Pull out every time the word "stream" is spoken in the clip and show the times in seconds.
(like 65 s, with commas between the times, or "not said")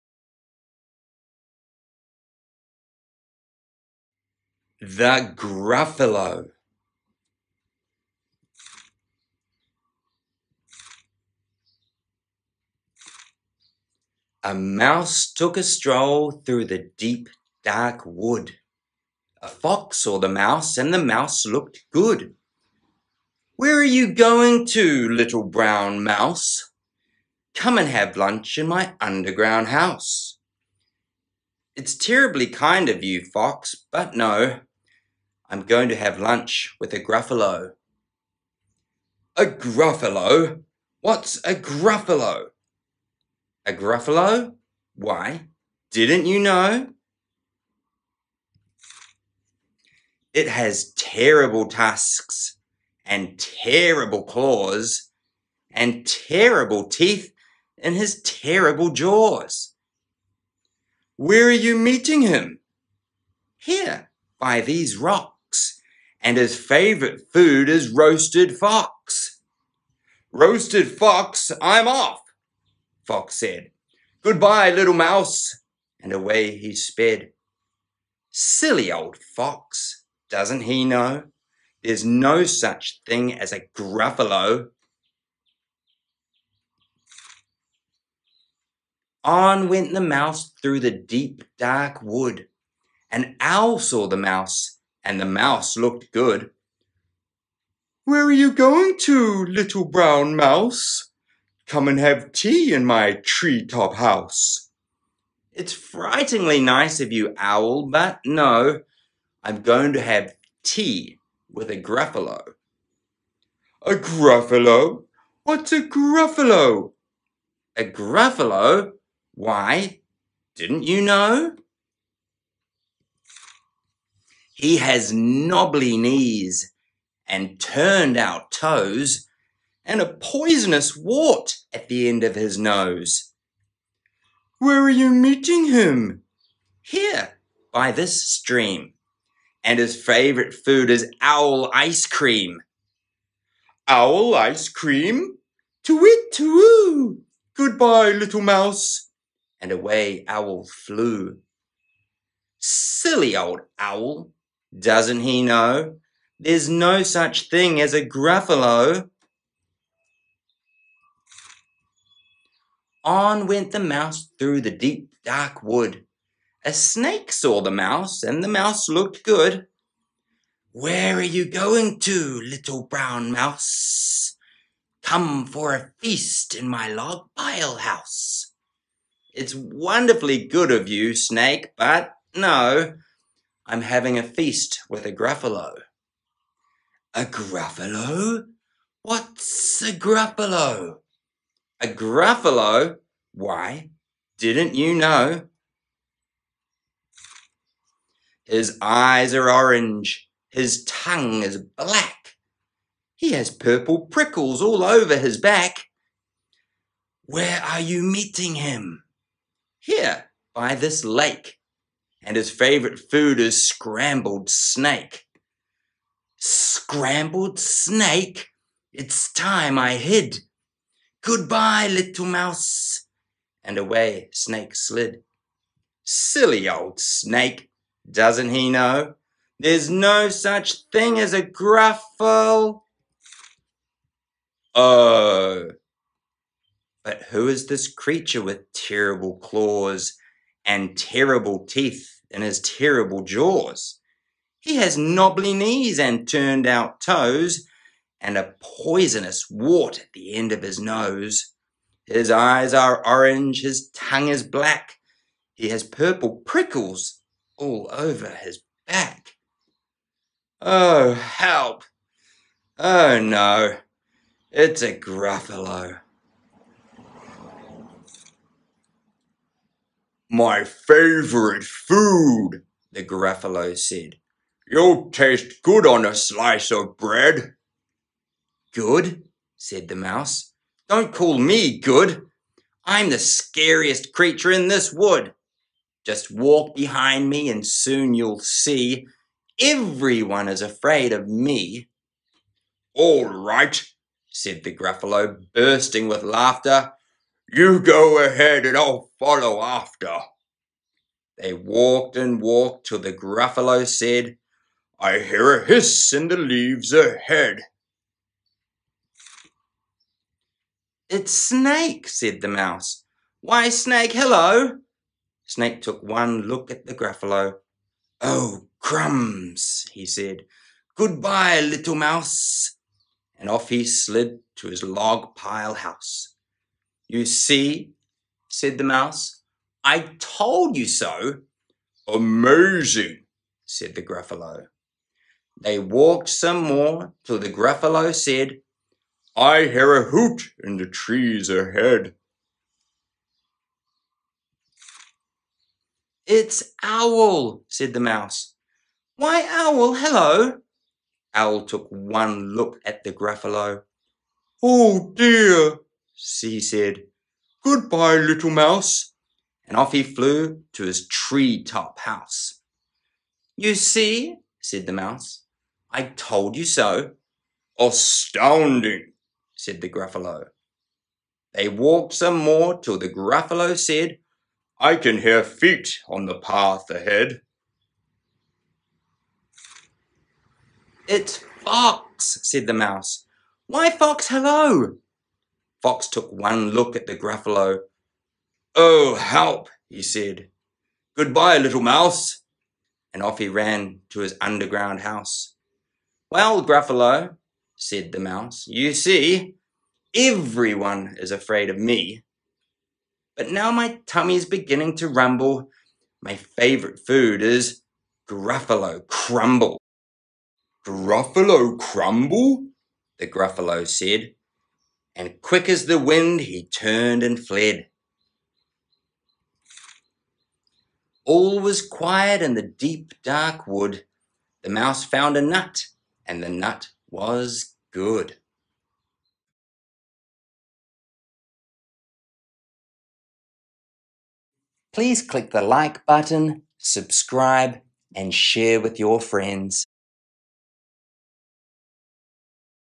138 s.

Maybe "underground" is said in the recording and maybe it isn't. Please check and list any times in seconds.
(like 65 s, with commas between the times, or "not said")
28 s, 394 s.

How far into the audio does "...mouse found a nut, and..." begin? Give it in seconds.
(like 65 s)
424 s.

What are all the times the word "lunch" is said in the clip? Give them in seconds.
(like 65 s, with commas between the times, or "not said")
28 s, 36 s.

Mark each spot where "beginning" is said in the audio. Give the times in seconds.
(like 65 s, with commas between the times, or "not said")
404 s.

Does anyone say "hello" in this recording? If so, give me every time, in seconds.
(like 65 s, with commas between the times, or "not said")
314 s, 349 s, 384 s.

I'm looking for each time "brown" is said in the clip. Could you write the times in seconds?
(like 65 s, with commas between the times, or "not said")
25 s, 99 s, 172 s.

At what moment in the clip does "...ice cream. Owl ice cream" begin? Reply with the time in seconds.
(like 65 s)
141 s.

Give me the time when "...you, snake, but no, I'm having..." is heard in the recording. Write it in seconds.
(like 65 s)
180 s.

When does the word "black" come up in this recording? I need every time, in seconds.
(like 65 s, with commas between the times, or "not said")
201 s, 254 s.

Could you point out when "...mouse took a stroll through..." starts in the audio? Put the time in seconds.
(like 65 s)
14 s.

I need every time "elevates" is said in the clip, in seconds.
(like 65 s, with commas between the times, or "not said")
not said.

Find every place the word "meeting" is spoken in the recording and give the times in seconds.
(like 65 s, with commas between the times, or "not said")
61 s, 135 s, 208 s.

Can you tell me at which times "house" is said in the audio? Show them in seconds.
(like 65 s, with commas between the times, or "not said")
29 s, 103 s, 177 s, 325 s, 362 s, 395 s.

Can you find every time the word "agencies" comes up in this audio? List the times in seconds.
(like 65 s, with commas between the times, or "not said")
not said.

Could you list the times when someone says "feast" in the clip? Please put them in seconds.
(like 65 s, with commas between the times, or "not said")
175 s, 184 s.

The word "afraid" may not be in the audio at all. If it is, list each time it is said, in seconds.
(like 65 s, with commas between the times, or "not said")
290 s, 401 s.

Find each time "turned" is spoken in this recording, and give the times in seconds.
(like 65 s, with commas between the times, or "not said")
127 s, 246 s, 416 s.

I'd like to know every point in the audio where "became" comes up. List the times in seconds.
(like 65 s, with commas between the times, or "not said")
not said.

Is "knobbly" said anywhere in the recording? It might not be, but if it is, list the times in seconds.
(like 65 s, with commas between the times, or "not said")
125 s, 244 s.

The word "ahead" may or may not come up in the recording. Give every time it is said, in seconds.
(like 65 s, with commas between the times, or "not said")
298 s, 306 s, 341 s, 376 s.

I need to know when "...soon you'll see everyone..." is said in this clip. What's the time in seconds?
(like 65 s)
287 s.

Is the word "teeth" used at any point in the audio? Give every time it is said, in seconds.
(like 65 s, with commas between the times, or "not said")
56 s, 241 s.